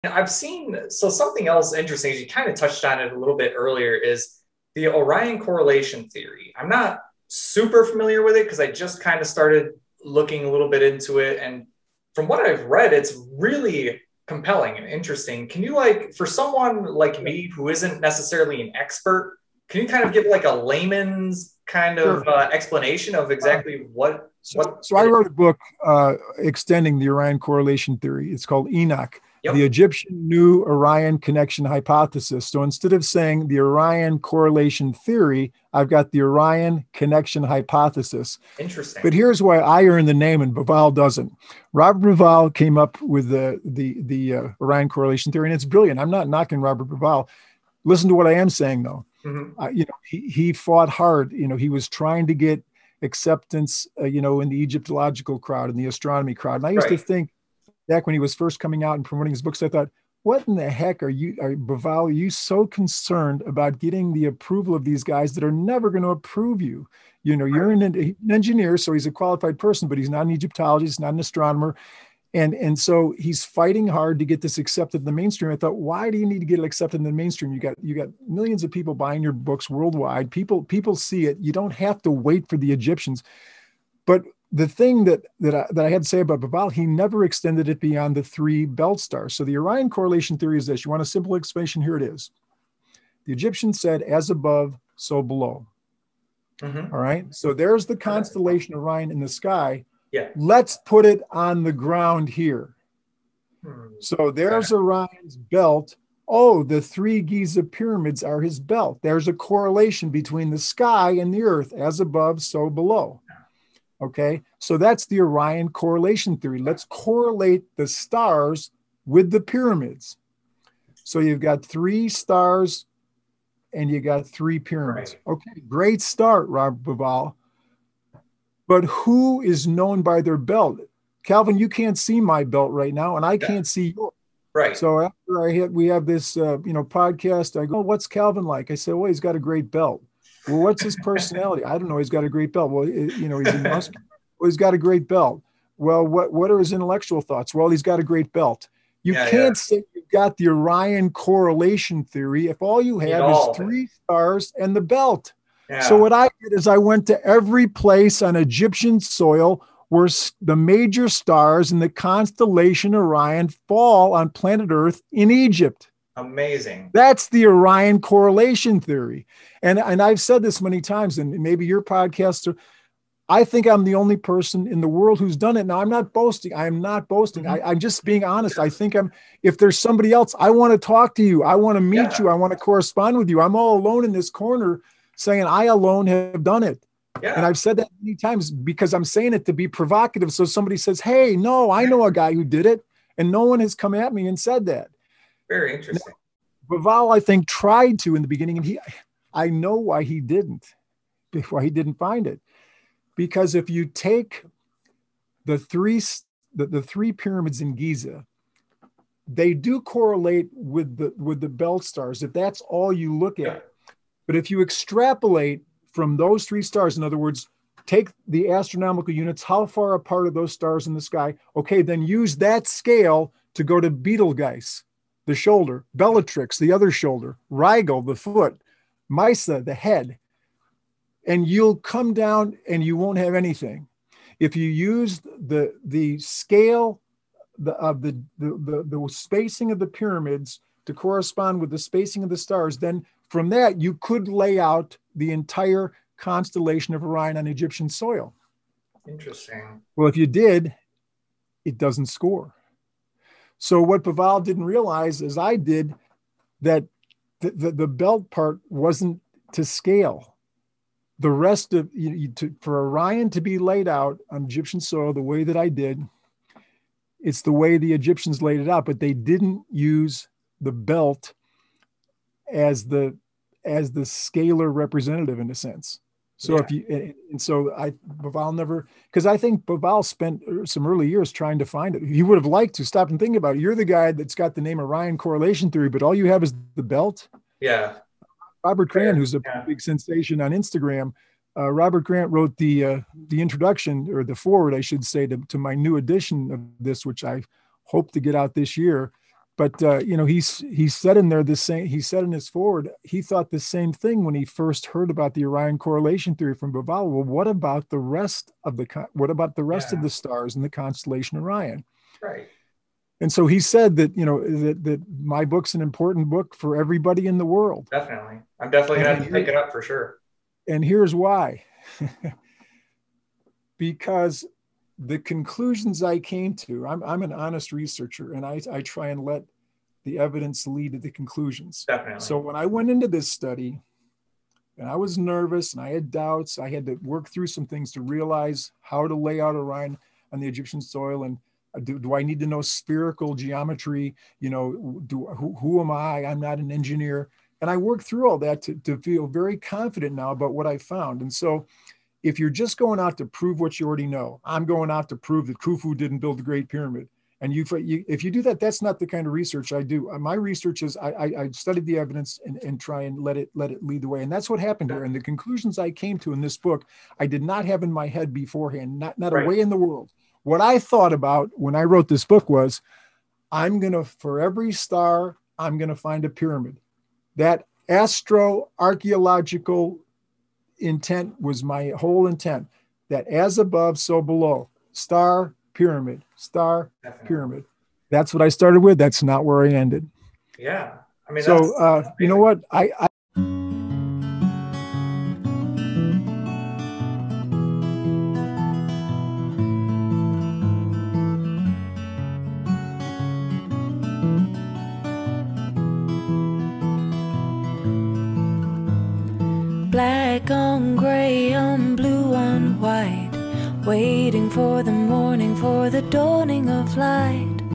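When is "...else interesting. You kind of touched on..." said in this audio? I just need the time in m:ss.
0:01.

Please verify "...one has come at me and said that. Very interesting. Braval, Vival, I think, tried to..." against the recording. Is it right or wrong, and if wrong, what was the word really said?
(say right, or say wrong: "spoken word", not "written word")
right.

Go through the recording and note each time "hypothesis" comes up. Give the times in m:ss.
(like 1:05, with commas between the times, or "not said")
0:31, 0:37.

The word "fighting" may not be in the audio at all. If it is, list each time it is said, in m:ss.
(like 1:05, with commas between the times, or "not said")
1:13.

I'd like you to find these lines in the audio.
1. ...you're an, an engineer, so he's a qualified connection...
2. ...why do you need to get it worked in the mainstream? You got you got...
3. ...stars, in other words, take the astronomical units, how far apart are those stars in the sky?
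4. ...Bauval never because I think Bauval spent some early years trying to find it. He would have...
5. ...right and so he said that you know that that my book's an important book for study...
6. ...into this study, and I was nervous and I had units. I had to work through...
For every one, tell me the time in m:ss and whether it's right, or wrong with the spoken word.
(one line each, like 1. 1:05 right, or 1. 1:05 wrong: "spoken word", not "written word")
1. 1:07 wrong: "person", not "connection"
2. 1:15 wrong: "accepted", not "worked"
3. 3:36 right
4. 4:37 right
5. 5:12 wrong: "everybody", not "study"
6. 5:32 wrong: "doubts", not "units".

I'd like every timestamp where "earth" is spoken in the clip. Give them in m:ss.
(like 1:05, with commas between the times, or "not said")
1:51, 2:44.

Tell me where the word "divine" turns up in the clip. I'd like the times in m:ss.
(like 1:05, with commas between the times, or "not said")
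not said.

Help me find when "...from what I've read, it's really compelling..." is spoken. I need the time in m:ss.
0:12.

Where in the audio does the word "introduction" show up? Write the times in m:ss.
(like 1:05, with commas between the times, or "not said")
4:53.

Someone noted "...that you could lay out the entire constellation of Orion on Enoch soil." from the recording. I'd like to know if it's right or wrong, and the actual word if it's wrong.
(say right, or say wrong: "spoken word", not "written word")
wrong: "Egyptian", not "Enoch".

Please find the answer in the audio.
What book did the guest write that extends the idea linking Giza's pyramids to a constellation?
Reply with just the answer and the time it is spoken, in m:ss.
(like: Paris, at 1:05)
Enoch, at 0:28.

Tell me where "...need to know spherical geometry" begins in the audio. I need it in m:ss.
5:42.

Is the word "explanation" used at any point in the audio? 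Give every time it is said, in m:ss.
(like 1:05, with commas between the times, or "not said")
0:22, 1:31.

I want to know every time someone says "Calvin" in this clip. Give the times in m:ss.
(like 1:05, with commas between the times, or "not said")
2:11, 2:18.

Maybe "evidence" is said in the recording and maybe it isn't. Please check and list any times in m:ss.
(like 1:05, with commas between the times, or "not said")
5:30, 6:01.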